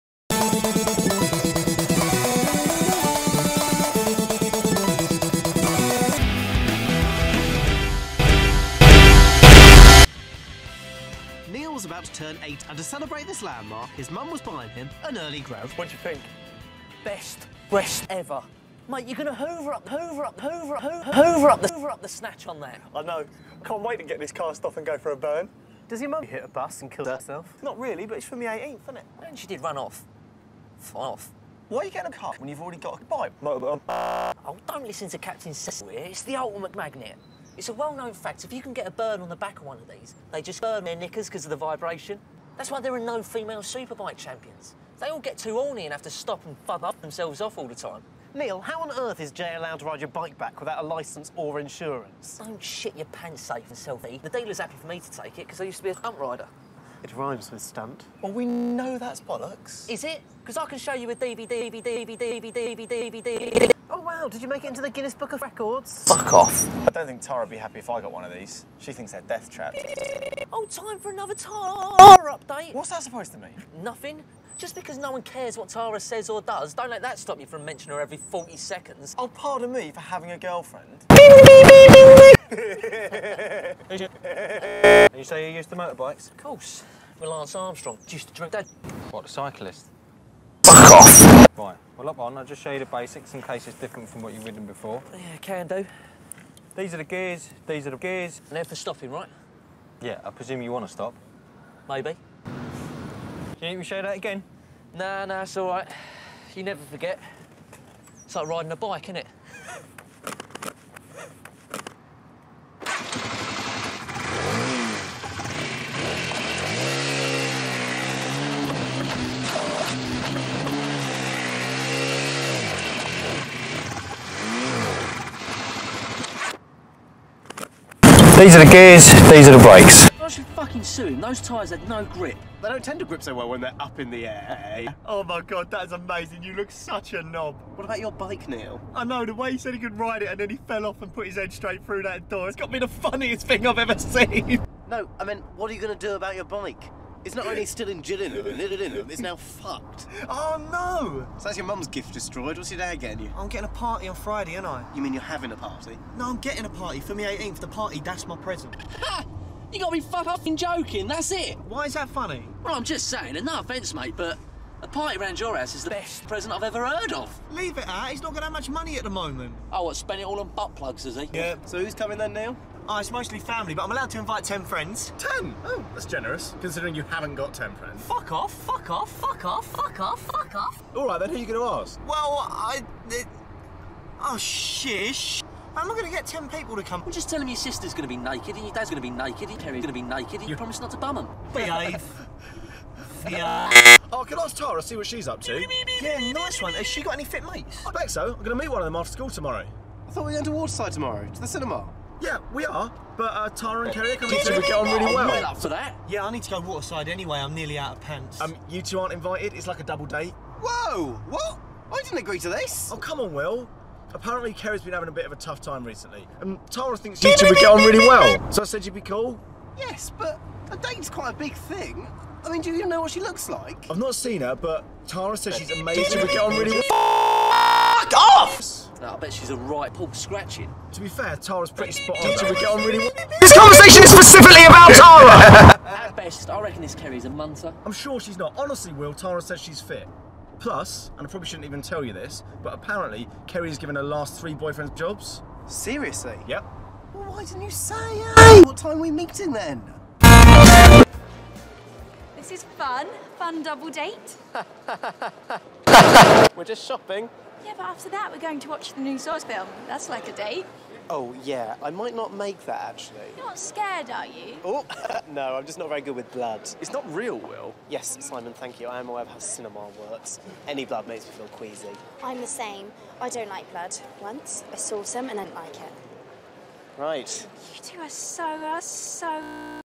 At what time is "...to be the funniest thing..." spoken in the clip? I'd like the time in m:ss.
2:22.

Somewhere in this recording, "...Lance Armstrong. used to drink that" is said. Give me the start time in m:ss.
1:27.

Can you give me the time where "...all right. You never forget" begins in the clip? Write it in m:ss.
1:45.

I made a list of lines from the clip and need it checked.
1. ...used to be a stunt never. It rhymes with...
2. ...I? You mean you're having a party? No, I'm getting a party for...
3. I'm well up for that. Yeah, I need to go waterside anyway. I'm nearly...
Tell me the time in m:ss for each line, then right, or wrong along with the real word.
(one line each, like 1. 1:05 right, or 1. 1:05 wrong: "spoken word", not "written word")
1. 0:55 wrong: "rider", not "never"
2. 2:34 right
3. 3:25 right.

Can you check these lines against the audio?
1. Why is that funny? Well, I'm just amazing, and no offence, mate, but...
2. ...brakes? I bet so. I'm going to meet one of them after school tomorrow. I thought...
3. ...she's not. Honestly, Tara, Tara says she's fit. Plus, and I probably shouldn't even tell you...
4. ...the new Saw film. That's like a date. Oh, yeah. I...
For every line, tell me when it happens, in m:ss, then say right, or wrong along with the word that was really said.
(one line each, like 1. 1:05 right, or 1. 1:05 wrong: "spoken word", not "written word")
1. 2:41 wrong: "saying", not "amazing"
2. 3:17 wrong: "mates", not "brakes"
3. 3:58 wrong: "Will", not "Tara"
4. 4:18 right.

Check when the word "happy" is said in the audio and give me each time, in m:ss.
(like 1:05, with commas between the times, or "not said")
0:54, 1:07.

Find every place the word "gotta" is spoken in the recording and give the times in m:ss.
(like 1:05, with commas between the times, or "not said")
2:39.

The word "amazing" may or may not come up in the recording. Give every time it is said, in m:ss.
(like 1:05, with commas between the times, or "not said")
2:15, 3:45.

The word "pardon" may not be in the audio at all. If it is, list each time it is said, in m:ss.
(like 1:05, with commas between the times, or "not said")
1:19.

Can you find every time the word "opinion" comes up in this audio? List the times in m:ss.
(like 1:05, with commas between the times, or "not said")
not said.